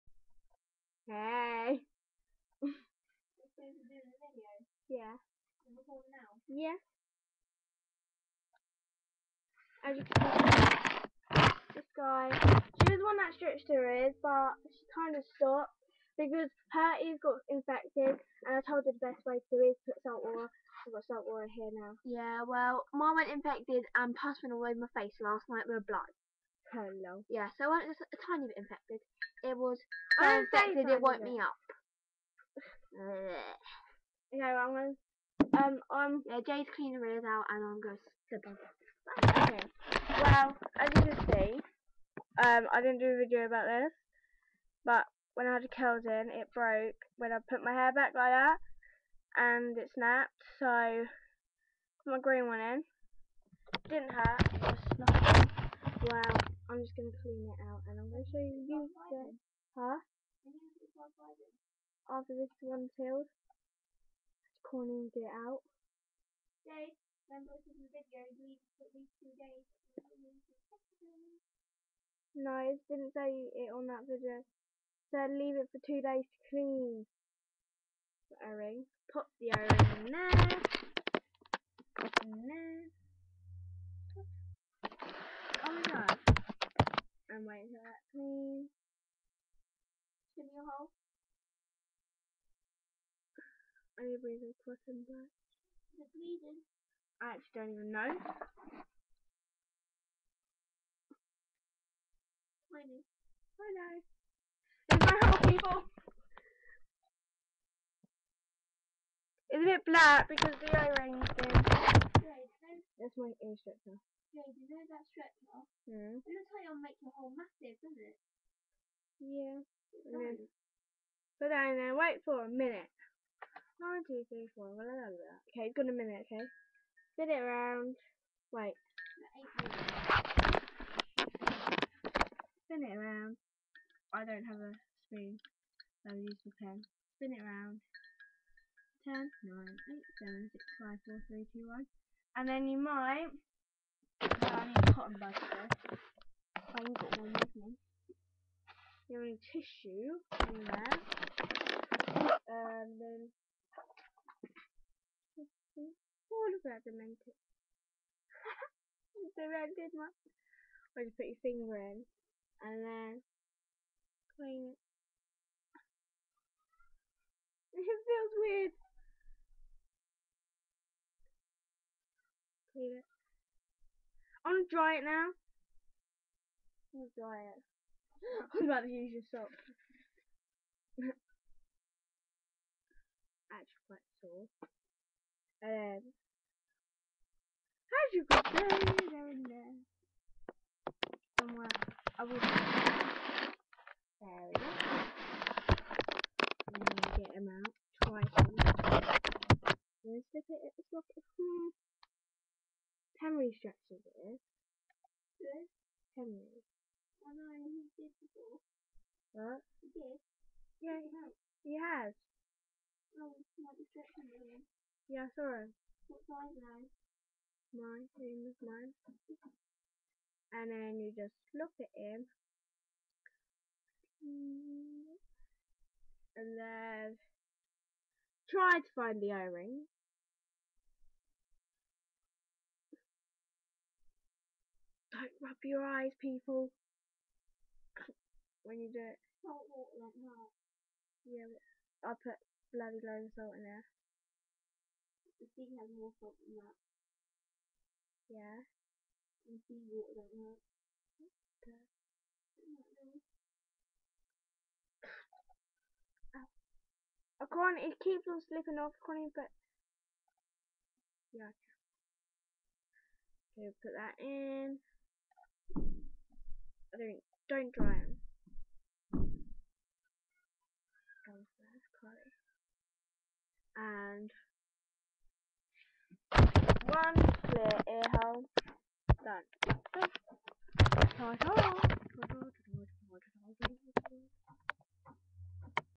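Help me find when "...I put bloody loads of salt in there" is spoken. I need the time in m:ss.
4:02.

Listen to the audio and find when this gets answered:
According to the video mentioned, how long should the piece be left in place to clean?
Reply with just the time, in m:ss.
1:15.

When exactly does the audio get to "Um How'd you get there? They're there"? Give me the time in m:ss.
3:05.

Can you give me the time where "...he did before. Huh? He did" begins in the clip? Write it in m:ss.
3:27.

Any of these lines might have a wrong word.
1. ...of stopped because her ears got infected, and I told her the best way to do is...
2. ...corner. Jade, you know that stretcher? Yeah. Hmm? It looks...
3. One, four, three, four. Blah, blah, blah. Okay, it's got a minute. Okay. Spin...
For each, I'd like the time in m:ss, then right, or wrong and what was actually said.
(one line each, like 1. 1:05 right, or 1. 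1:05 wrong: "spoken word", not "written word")
1. 0:15 right
2. 1:53 wrong: "stretcher", not "corner"
3. 2:03 wrong: "two", not "four".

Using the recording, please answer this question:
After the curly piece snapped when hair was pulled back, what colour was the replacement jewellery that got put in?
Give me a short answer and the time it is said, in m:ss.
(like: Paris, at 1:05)
Green, at 0:52.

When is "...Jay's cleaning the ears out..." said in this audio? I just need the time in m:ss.
0:36.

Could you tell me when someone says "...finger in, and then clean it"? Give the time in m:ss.
2:41.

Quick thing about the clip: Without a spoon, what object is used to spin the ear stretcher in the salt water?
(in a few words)
Pen.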